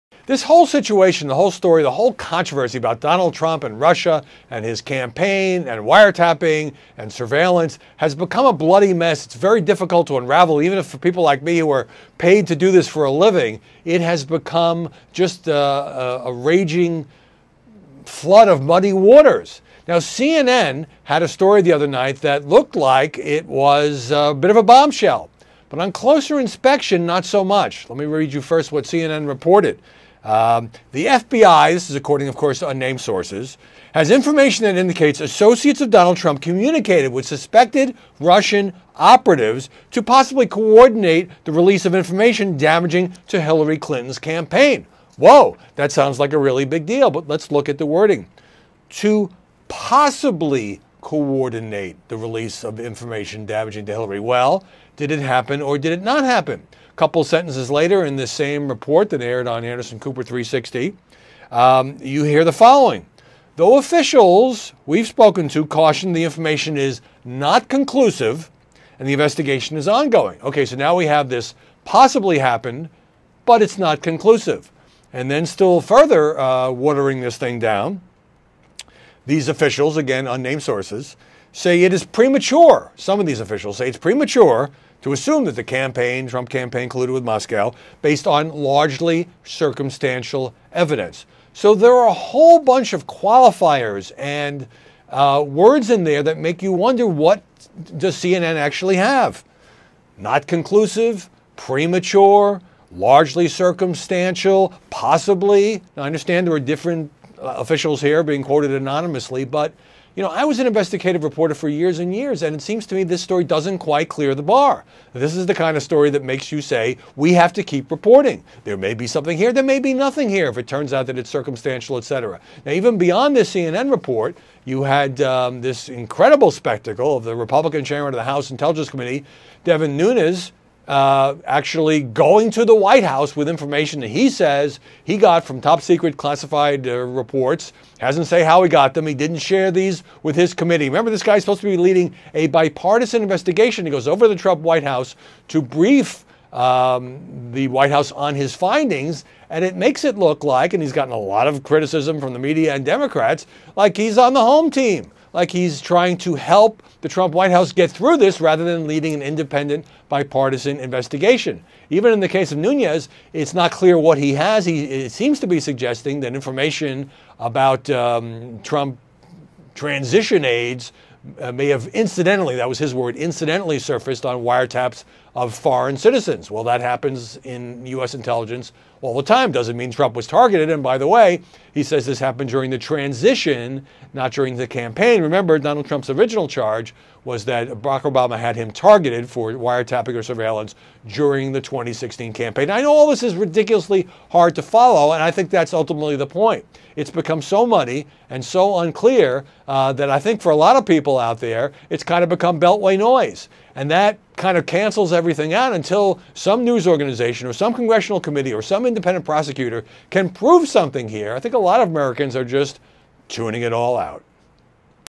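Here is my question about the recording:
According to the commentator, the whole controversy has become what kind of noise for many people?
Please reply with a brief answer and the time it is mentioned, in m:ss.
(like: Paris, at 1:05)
beltway noise, at 3:22.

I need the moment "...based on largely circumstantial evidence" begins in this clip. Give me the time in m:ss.
1:28.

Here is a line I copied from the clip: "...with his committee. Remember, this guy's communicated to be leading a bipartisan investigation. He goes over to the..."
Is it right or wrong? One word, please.
wrong.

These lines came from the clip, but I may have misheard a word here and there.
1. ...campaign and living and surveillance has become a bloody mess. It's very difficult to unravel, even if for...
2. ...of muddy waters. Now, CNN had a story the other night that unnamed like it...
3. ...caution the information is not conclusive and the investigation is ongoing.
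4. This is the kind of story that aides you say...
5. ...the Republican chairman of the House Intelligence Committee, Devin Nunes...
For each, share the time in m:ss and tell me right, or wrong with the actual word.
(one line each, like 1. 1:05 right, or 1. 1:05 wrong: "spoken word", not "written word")
1. 0:04 wrong: "wiretapping", not "living"
2. 0:18 wrong: "looked", not "unnamed"
3. 1:05 right
4. 1:55 wrong: "makes", not "aides"
5. 2:07 right.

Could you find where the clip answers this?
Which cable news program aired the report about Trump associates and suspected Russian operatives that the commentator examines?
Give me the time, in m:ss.
0:59.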